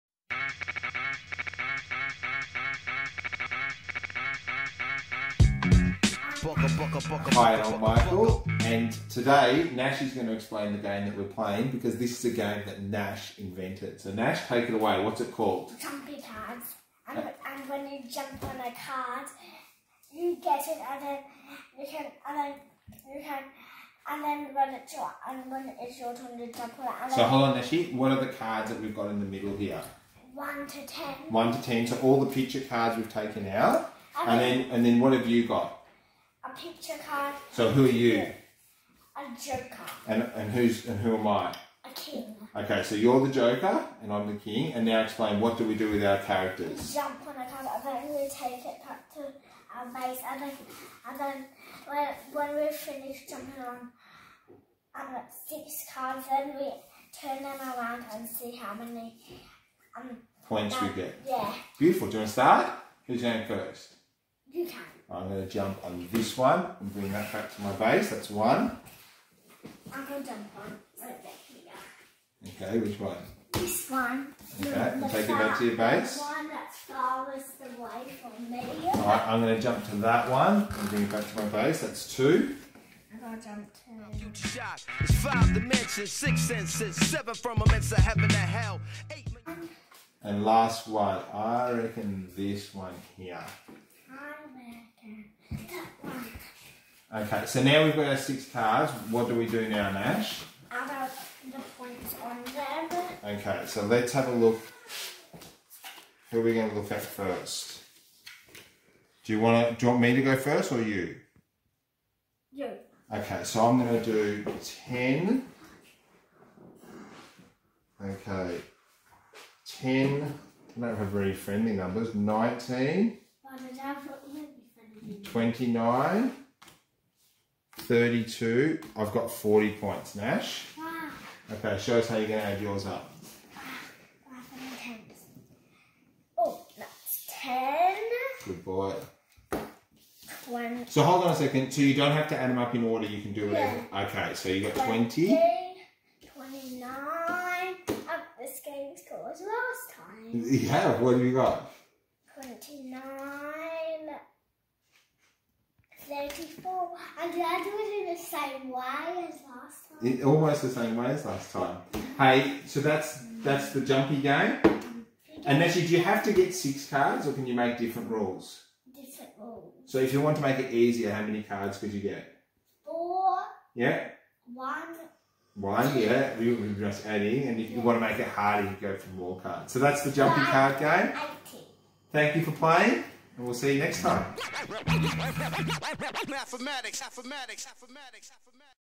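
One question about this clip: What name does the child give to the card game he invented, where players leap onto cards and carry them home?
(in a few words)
Jumpy cards.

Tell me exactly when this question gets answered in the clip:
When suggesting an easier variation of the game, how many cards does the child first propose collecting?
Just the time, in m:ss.
2:52.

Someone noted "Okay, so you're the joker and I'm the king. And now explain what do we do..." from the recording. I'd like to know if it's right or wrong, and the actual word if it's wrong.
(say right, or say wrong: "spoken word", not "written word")
right.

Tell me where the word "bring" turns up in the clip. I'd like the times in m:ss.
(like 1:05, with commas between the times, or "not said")
1:06, 1:20.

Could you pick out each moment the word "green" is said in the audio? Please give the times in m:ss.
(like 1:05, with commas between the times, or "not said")
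not said.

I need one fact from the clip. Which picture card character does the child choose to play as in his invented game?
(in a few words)
A joker.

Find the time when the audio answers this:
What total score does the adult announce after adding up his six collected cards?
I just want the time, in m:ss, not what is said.
2:09.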